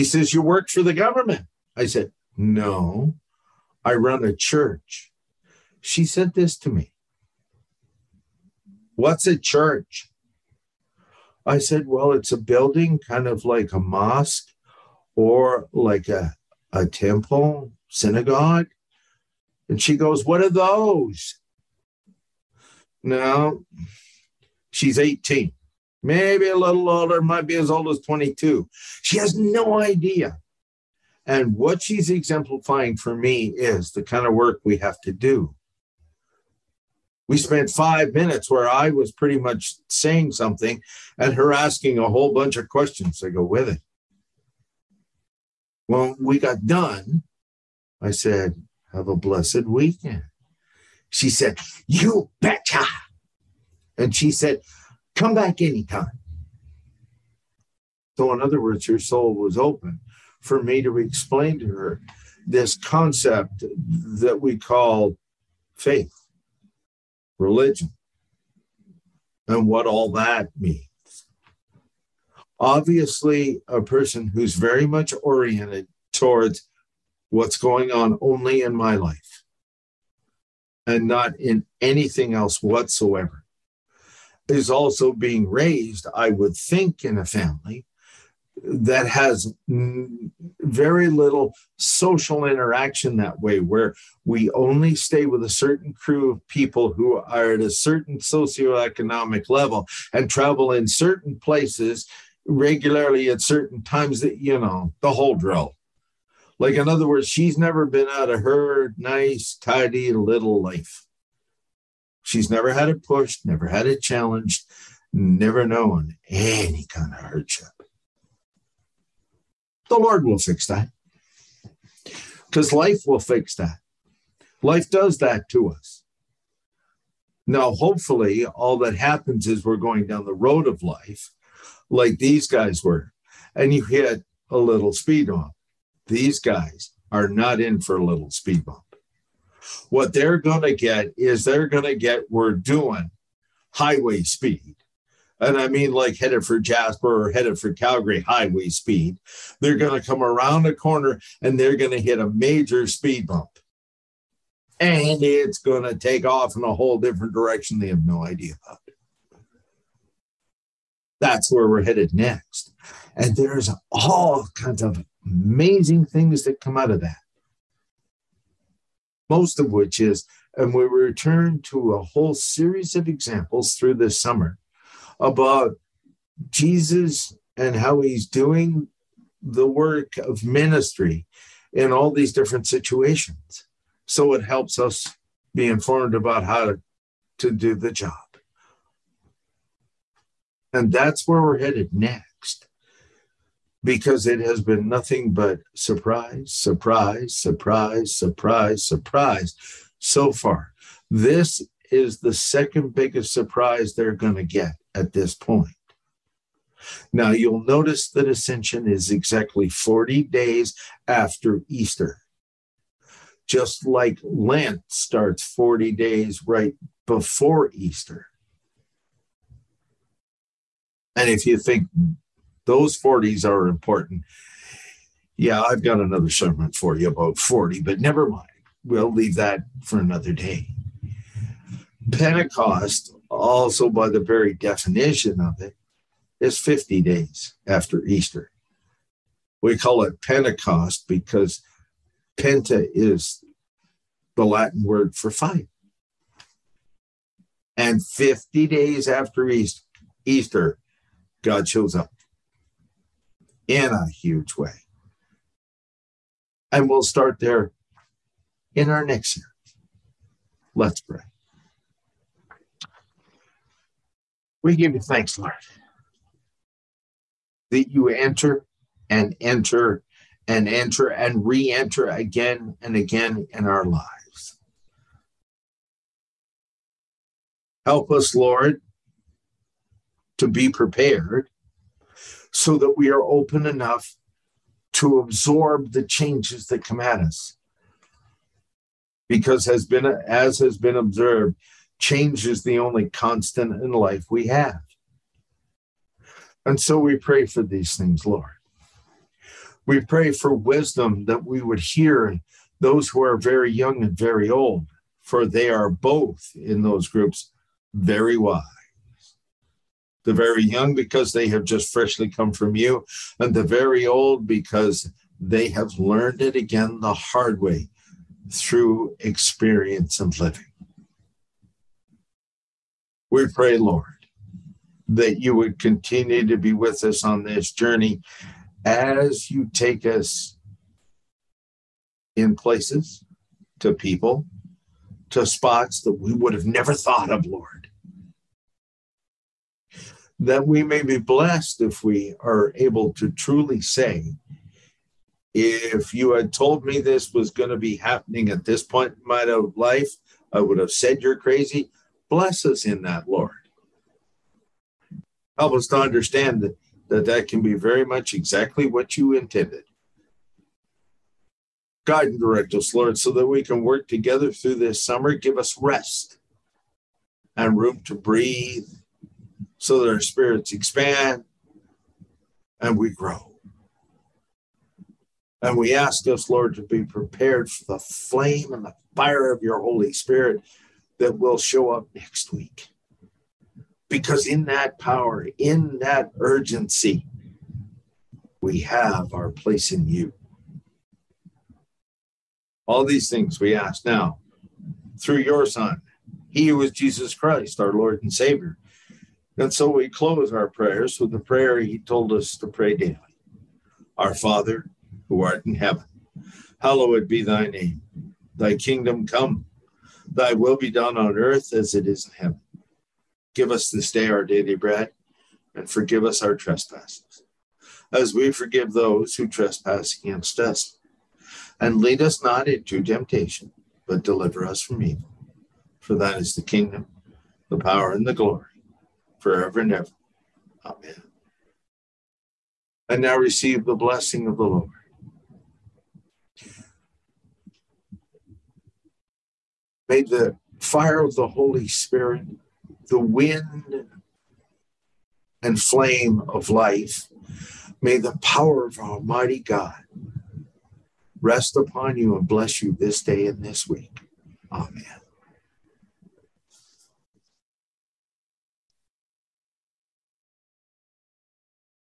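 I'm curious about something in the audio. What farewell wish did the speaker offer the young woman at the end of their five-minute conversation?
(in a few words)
Have a blessed weekend.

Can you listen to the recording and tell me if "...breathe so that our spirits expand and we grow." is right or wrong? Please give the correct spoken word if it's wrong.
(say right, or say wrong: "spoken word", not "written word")
right.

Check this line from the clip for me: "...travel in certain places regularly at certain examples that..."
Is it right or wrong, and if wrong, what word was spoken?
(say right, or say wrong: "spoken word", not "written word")
wrong: "times", not "examples".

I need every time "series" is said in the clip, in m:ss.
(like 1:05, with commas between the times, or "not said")
2:52, 4:19.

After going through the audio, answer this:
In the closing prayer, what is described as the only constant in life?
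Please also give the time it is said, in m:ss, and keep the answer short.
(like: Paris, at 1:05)
Change, at 4:52.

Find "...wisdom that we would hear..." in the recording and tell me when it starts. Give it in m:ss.
5:00.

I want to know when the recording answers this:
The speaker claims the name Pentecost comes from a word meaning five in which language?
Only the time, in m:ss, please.
4:04.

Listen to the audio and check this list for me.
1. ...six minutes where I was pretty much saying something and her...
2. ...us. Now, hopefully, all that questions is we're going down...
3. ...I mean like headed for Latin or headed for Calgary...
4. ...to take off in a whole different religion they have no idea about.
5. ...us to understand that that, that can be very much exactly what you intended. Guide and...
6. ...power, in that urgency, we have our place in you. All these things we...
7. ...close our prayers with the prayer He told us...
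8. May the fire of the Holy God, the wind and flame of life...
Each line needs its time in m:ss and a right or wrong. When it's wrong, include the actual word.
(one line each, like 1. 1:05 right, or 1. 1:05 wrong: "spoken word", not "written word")
1. 0:37 wrong: "five", not "six"
2. 2:05 wrong: "happens", not "questions"
3. 2:25 wrong: "Jasper", not "Latin"
4. 2:35 wrong: "direction", not "religion"
5. 5:55 right
6. 6:24 right
7. 6:40 right
8. 7:20 wrong: "Spirit", not "God".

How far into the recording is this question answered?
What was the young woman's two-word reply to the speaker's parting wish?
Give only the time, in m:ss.
0:51.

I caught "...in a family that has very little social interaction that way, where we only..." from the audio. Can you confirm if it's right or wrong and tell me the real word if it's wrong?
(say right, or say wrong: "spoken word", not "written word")
right.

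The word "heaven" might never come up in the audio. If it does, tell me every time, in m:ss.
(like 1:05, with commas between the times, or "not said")
6:45, 6:52.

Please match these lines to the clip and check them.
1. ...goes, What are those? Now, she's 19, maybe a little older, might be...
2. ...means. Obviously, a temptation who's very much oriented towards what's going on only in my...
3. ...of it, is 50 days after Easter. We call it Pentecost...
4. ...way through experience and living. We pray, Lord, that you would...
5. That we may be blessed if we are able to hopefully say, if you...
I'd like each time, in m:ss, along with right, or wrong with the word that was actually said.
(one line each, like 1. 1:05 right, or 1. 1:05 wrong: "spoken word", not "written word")
1. 0:19 wrong: "18", not "19"
2. 1:10 wrong: "person", not "temptation"
3. 3:55 right
4. 5:17 right
5. 5:40 wrong: "truly", not "hopefully".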